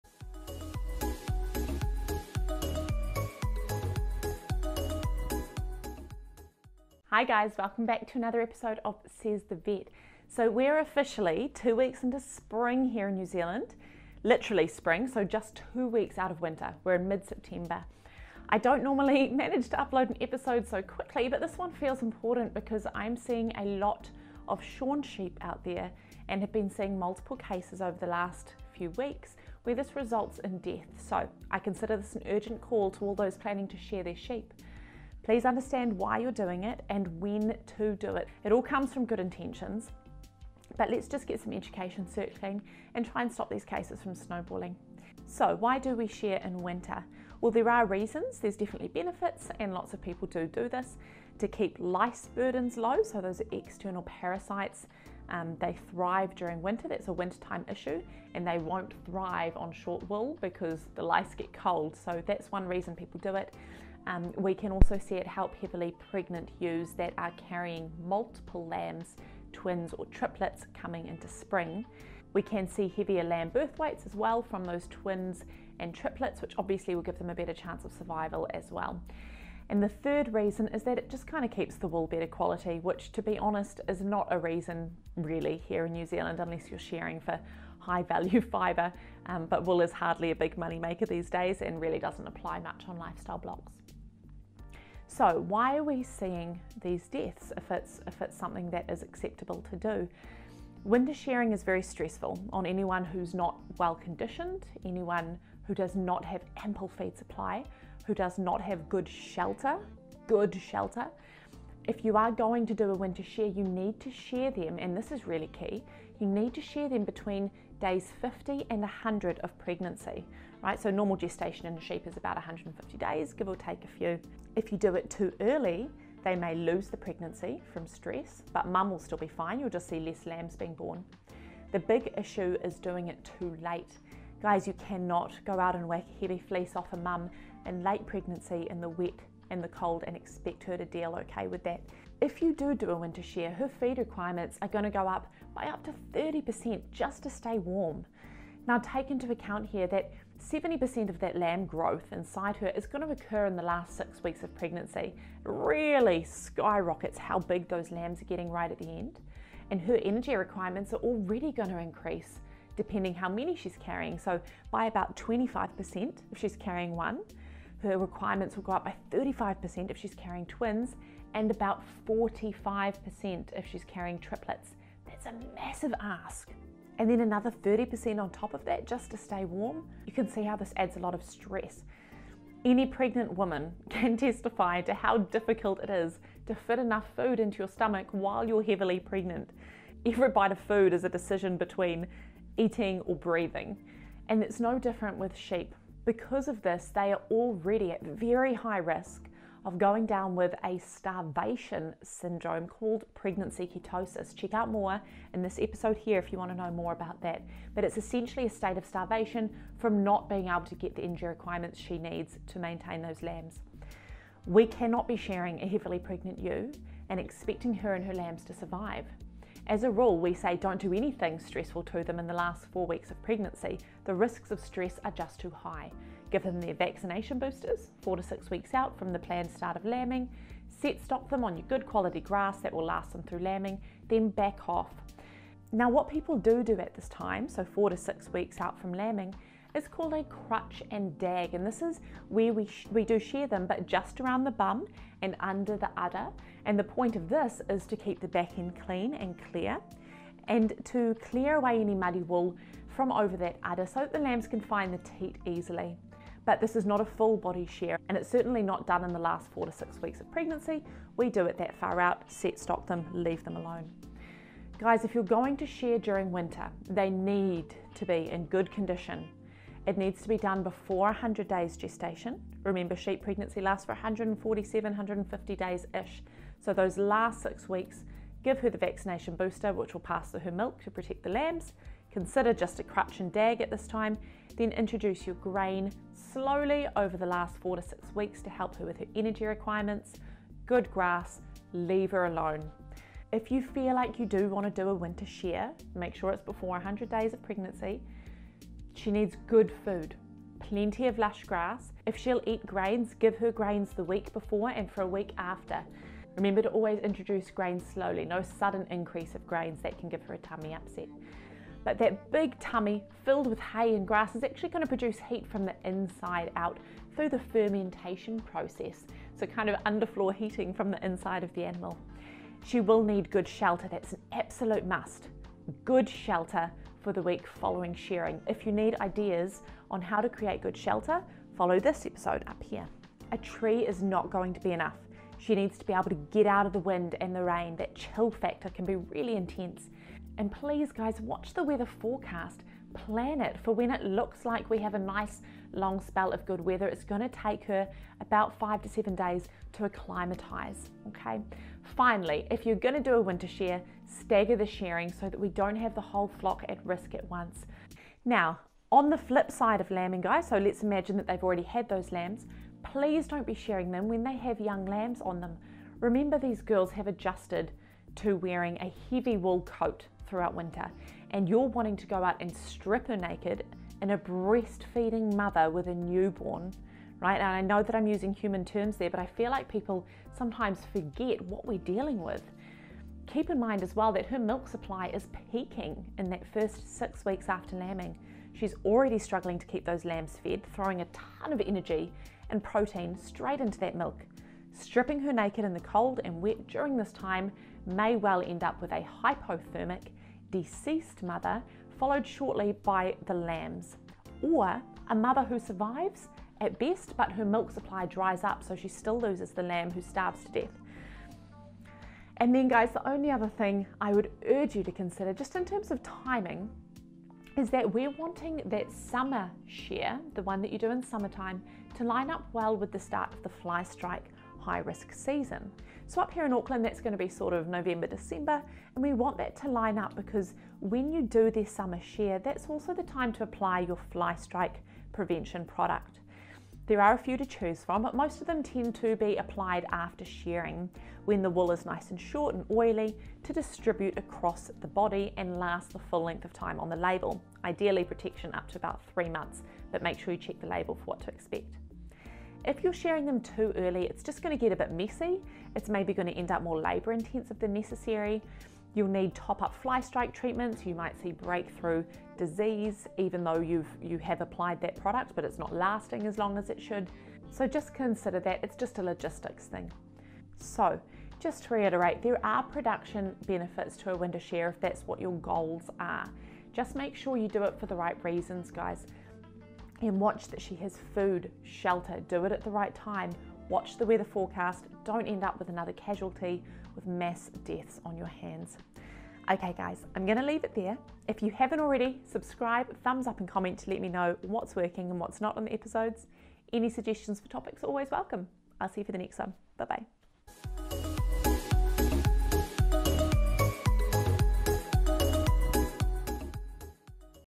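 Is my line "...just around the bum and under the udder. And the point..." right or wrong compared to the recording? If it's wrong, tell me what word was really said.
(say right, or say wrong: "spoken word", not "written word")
right.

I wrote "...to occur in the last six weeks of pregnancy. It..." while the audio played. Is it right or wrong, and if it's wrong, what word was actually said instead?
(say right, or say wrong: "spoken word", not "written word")
right.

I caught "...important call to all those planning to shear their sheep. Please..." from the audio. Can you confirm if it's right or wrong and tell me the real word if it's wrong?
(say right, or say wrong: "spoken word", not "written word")
wrong: "urgent", not "important".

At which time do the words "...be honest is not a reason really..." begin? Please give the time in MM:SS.
01:23.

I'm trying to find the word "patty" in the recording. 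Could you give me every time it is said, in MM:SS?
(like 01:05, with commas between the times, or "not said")
not said.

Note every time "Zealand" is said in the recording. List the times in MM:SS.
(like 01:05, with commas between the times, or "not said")
00:13, 01:26.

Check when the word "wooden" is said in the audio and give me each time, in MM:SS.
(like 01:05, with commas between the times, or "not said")
not said.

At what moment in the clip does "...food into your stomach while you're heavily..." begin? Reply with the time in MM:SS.
03:07.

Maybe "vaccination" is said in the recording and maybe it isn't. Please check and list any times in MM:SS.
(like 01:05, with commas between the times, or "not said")
03:46, 04:38.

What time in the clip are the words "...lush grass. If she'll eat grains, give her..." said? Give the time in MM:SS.
05:01.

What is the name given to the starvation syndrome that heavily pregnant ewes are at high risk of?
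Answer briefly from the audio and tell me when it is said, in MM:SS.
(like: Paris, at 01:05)
pregnancy ketosis, at 03:23.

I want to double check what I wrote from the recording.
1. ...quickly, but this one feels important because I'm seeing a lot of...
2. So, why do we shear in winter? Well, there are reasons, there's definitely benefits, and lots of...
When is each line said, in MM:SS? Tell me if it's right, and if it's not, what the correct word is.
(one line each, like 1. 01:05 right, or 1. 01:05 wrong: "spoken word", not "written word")
1. 00:20 right
2. 00:45 right.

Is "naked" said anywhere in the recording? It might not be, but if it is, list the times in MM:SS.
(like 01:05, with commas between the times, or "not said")
06:13, 06:35.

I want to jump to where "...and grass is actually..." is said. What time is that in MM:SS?
05:13.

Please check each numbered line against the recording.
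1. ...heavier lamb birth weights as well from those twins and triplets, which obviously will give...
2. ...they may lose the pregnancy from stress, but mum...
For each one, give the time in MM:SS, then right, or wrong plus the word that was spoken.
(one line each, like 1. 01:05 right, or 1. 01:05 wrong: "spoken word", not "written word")
1. 01:12 right
2. 02:06 right.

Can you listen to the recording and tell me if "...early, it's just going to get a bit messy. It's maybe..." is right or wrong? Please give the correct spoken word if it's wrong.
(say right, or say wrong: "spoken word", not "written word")
right.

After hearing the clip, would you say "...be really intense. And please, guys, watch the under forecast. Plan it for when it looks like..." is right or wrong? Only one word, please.
wrong.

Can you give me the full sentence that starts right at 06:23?
Keep in mind as well that her milk supply is peaking in that first six weeks after lambing.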